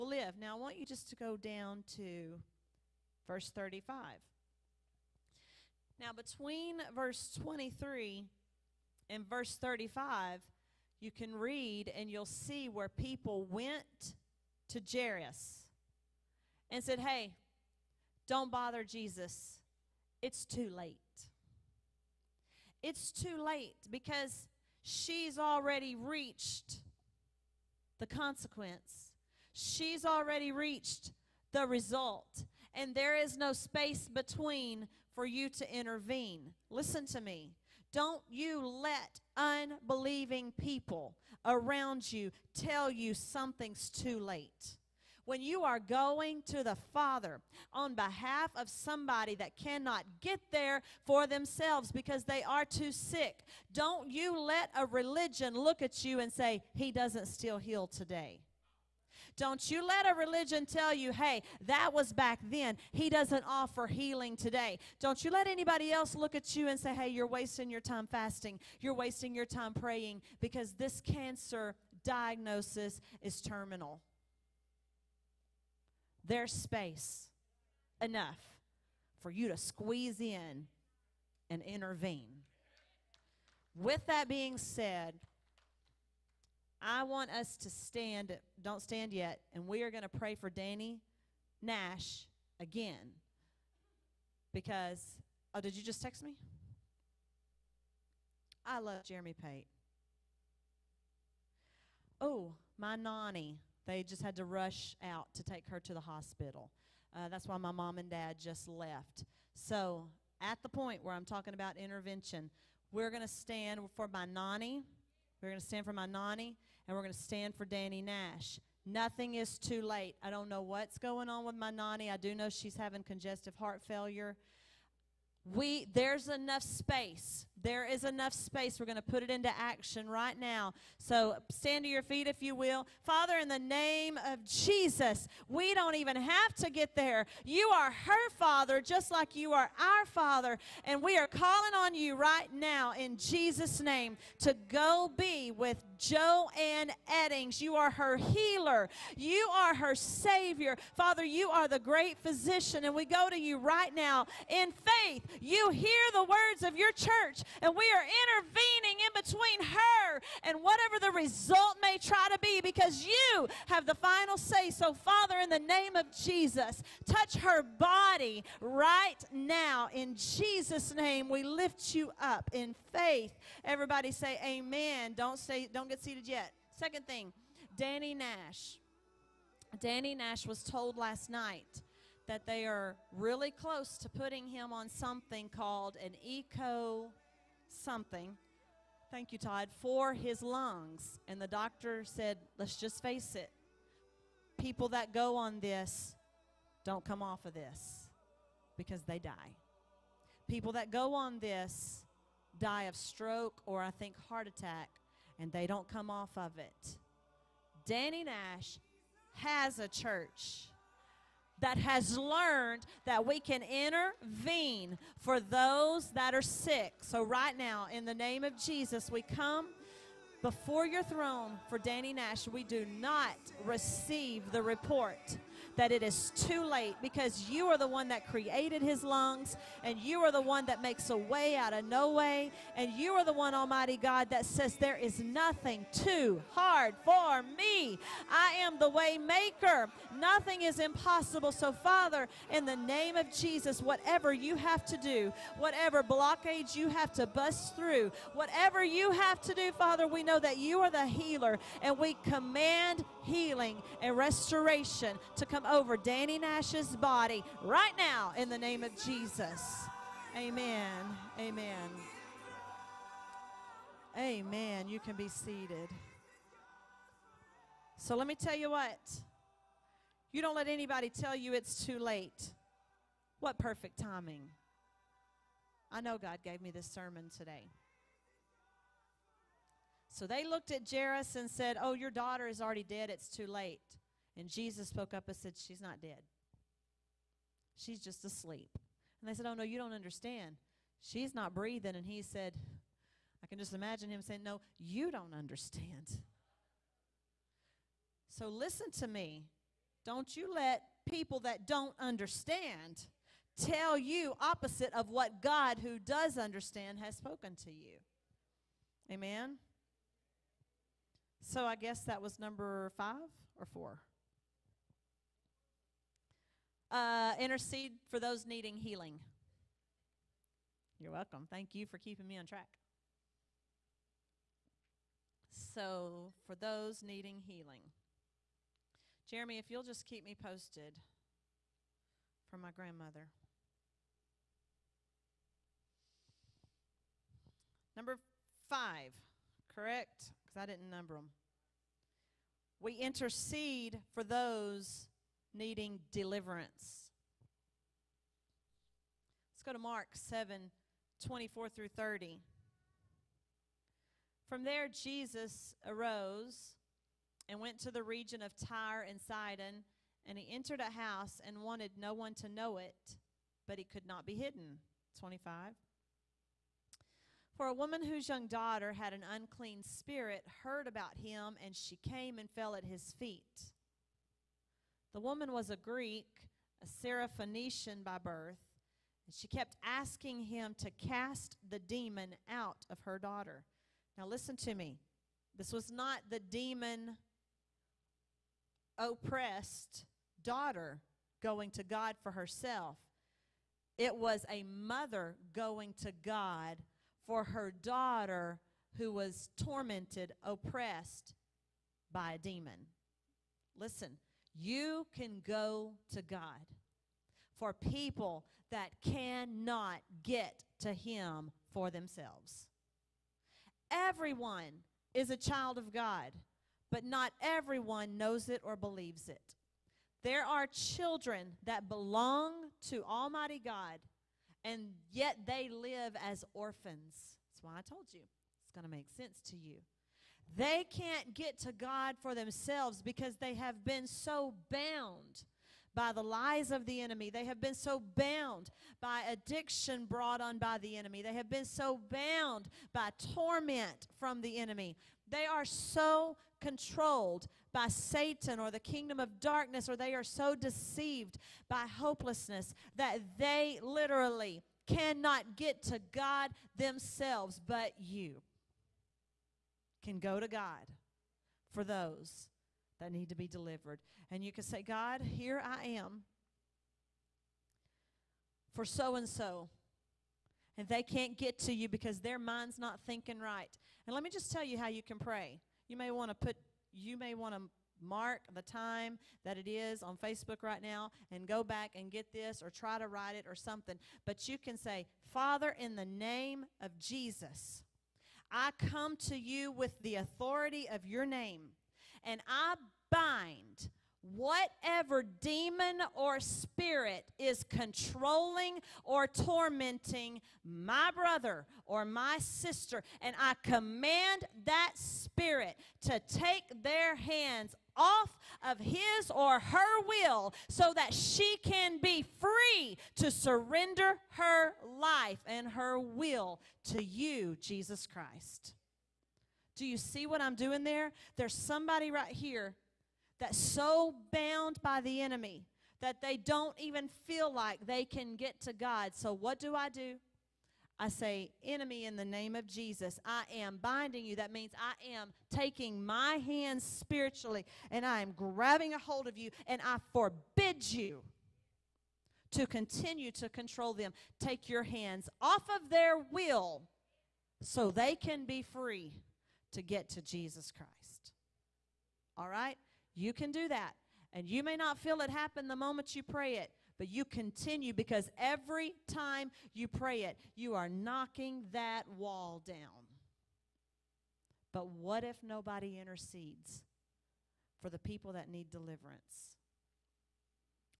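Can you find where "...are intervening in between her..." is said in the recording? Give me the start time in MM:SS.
02:37.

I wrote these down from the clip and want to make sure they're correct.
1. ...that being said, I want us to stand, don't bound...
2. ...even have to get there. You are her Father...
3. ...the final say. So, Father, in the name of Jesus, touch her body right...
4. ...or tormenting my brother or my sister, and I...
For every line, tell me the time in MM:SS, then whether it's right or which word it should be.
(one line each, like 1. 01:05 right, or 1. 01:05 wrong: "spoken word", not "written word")
1. 01:24 wrong: "stand", not "bound"
2. 02:15 right
3. 02:43 right
4. 08:19 right.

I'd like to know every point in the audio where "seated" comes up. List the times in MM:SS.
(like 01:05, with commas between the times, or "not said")
02:56, 04:25.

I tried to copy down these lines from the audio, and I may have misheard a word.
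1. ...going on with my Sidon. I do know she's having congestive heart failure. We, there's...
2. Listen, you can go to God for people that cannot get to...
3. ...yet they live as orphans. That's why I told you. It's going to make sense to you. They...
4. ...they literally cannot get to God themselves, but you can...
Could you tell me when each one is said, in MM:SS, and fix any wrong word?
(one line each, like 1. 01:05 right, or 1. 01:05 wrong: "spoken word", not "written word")
1. 02:00 wrong: "Nani", not "Sidon"
2. 06:43 right
3. 07:05 right
4. 07:33 right.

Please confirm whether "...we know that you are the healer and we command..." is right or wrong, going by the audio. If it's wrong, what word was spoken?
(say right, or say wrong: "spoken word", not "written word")
right.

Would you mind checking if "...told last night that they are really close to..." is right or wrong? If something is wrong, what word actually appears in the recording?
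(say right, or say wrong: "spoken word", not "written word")
right.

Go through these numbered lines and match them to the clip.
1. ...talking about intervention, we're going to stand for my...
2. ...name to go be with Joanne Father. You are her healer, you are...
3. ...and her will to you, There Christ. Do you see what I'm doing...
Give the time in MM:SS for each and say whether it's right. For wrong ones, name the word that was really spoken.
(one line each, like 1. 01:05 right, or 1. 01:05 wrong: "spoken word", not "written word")
1. 01:51 right
2. 02:23 wrong: "Eddings", not "Father"
3. 08:35 wrong: "Jesus", not "There".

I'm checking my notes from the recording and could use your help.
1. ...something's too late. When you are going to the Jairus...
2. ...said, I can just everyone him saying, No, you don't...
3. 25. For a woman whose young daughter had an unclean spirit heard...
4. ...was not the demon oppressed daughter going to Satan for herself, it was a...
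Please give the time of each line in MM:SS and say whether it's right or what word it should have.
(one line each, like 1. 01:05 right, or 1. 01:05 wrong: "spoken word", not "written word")
1. 00:43 wrong: "Father", not "Jairus"
2. 04:52 wrong: "imagine", not "everyone"
3. 06:05 right
4. 06:25 wrong: "God", not "Satan".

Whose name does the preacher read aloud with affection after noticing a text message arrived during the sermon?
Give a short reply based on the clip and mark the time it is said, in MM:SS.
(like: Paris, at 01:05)
Jeremy Pate, at 01:39.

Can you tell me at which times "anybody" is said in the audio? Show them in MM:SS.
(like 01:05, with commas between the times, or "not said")
01:05, 04:30.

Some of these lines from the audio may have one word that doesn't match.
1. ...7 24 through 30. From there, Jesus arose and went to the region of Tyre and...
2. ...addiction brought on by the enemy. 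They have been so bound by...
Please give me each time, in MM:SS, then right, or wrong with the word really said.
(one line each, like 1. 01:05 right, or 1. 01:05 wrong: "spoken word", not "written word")
1. 05:50 right
2. 07:19 right.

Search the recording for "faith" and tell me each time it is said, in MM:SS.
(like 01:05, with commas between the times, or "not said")
02:34, 02:52.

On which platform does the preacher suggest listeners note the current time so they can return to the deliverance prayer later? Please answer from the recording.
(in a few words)
Facebook.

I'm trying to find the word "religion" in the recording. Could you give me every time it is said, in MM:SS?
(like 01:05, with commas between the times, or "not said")
00:54, 01:00.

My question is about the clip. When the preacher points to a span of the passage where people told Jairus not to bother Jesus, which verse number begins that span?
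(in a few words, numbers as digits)
23.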